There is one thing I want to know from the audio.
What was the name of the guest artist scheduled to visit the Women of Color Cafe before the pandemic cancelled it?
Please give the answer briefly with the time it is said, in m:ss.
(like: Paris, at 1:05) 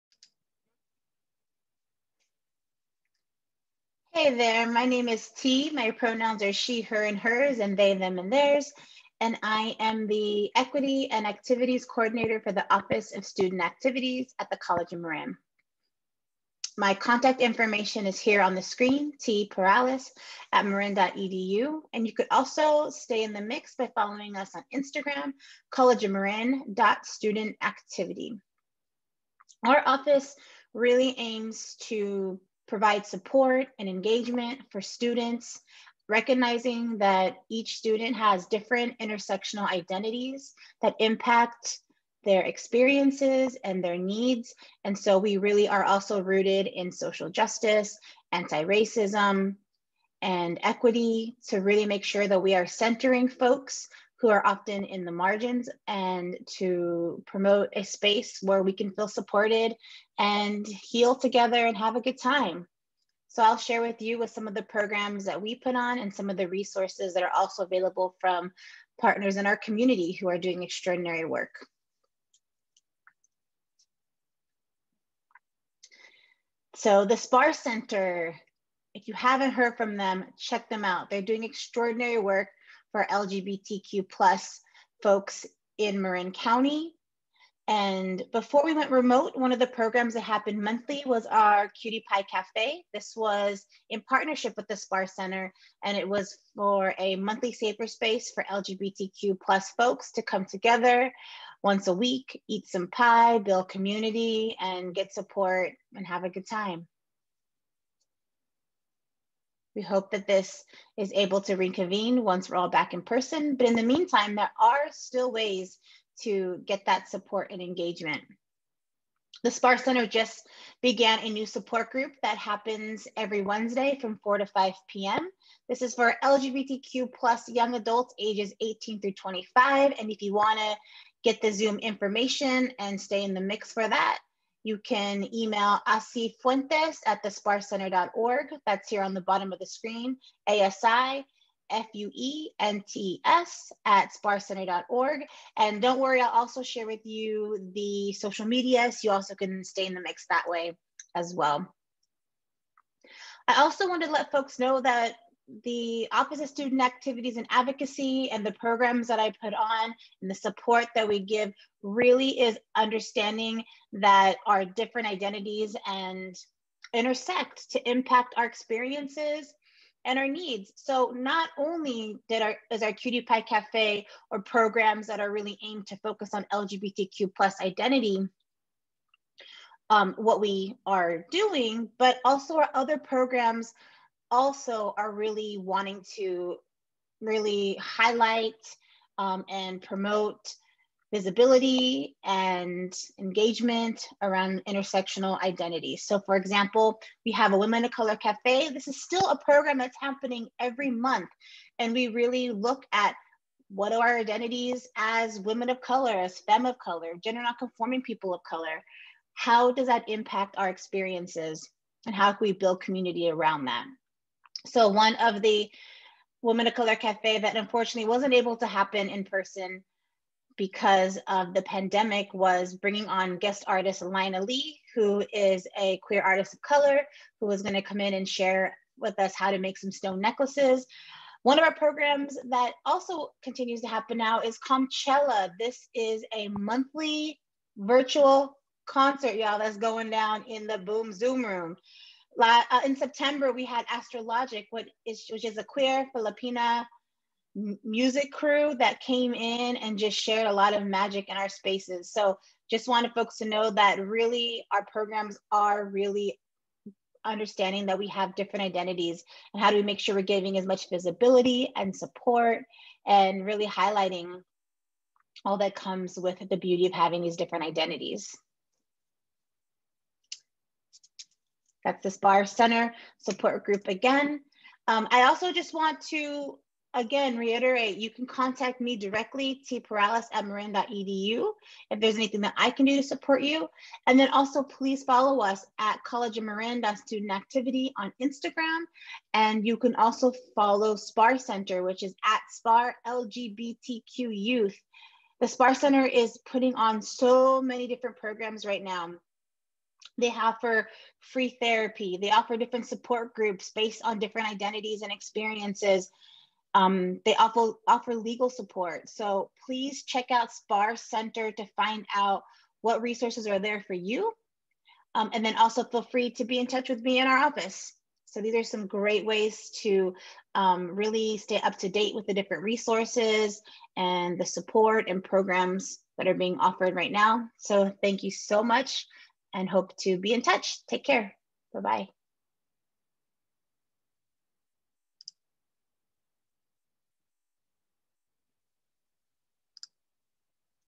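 Lina Lee, at 3:44.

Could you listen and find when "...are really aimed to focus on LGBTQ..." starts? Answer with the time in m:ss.
2:55.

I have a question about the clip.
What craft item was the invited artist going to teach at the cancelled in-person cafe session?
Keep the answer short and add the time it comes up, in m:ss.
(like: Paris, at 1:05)
Stone necklaces, at 3:49.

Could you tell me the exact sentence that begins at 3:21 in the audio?
And we really look at what are our identities as women of color, as femme of color, gender nonconforming people of color?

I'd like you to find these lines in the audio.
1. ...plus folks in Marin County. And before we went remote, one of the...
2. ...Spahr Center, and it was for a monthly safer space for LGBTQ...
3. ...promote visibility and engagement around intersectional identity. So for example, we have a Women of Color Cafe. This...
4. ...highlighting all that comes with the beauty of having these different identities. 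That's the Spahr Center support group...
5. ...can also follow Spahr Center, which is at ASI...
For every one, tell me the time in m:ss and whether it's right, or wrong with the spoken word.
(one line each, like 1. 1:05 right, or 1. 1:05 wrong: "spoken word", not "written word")
1. 1:24 right
2. 1:34 right
3. 3:09 right
4. 4:23 right
5. 4:49 wrong: "Spahr", not "ASI".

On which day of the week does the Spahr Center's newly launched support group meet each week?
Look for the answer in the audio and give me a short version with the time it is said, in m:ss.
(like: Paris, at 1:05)
Wednesday, at 2:03.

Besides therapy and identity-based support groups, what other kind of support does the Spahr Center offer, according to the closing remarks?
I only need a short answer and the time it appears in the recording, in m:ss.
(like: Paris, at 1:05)
Legal support, at 5:08.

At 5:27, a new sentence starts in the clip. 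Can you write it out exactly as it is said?
So thank you so much and hope to be in touch.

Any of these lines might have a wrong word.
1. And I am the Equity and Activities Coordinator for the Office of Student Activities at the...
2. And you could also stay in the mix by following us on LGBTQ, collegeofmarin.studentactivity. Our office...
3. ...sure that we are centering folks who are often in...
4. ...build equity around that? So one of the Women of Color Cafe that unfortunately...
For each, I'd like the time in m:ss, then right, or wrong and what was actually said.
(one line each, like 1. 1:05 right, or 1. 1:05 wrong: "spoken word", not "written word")
1. 0:09 right
2. 0:21 wrong: "Instagram", not "LGBTQ"
3. 0:52 right
4. 3:32 wrong: "community", not "equity".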